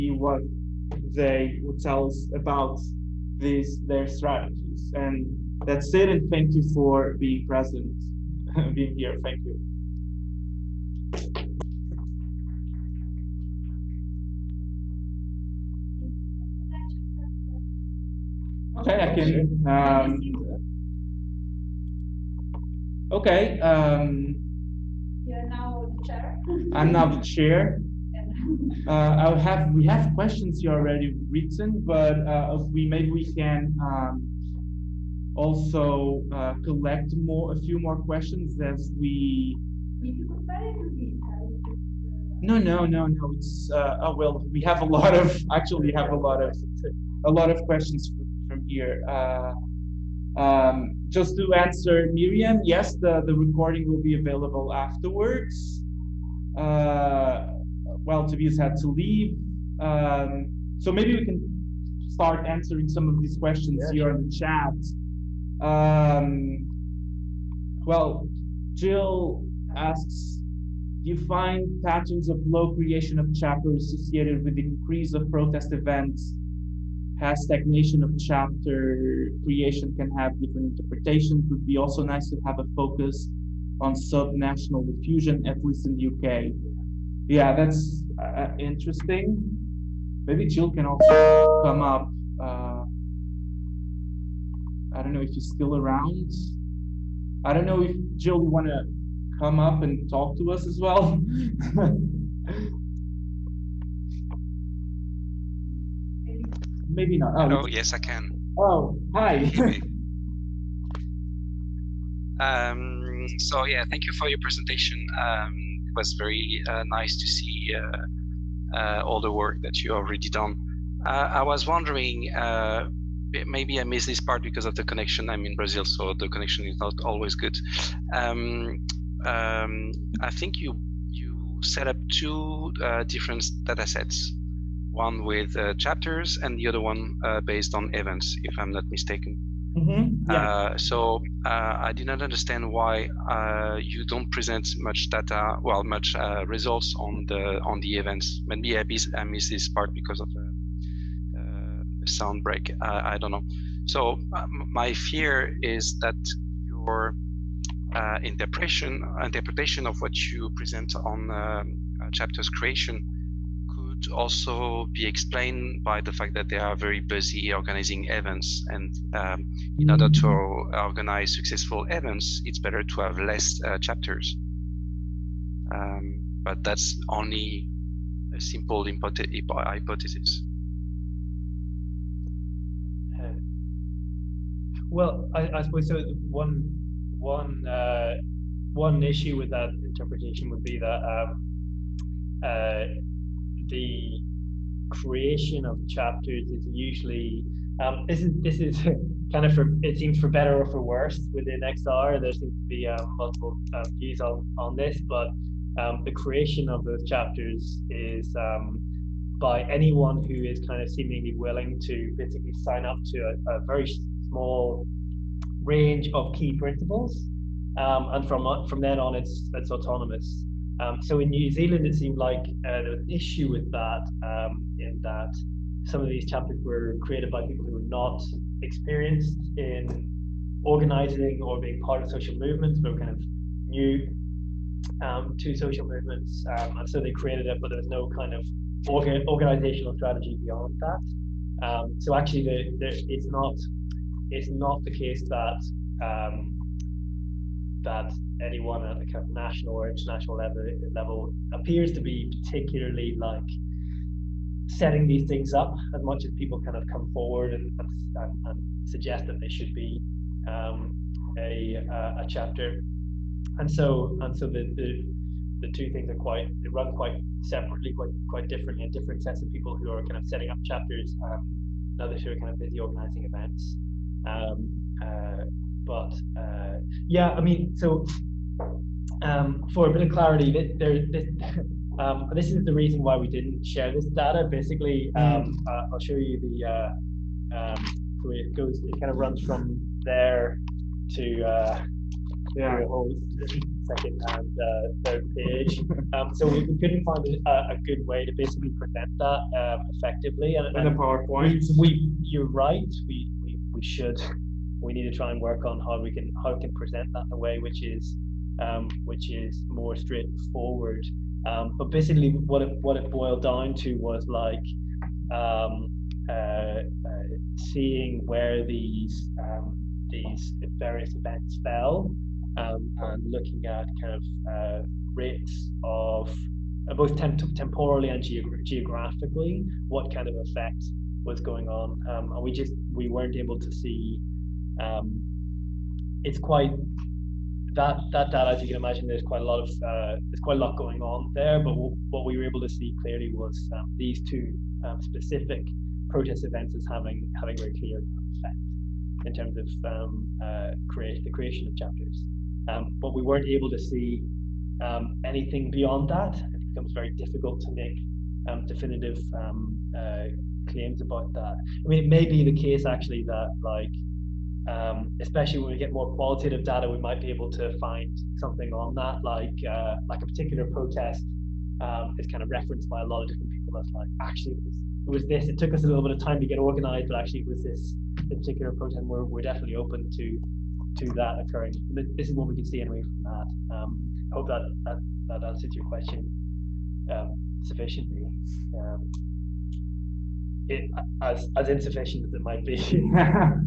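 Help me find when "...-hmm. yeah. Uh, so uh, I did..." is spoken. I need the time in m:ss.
2:19.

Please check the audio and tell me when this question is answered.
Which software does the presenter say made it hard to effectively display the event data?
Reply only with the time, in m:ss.
5:00.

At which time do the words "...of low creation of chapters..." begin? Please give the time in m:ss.
1:12.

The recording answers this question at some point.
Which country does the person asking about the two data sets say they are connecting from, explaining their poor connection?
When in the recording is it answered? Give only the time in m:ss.
2:05.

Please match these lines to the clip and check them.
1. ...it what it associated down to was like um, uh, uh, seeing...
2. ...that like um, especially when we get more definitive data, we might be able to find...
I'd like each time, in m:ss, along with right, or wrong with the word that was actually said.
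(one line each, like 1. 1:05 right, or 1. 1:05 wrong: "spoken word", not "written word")
1. 5:12 wrong: "boiled", not "associated"
2. 6:03 wrong: "qualitative", not "definitive".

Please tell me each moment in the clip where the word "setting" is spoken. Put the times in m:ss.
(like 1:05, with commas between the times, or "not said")
4:14, 4:30.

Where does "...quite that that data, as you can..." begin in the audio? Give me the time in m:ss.
5:36.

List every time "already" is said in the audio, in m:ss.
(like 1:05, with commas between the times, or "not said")
0:30, 1:59.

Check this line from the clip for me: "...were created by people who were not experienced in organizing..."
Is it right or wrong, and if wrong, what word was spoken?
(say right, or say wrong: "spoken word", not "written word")
right.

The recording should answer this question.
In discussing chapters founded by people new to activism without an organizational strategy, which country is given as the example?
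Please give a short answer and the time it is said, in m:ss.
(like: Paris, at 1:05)
New Zealand, at 3:41.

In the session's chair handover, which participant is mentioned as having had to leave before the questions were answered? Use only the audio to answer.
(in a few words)
Tobias.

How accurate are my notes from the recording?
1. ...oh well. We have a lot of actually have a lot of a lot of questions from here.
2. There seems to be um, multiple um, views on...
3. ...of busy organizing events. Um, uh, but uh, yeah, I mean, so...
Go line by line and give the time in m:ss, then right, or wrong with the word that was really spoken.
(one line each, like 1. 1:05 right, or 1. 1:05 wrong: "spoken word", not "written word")
1. 0:44 right
2. 3:22 right
3. 4:32 right.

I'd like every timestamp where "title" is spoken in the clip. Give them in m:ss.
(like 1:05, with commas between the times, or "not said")
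not said.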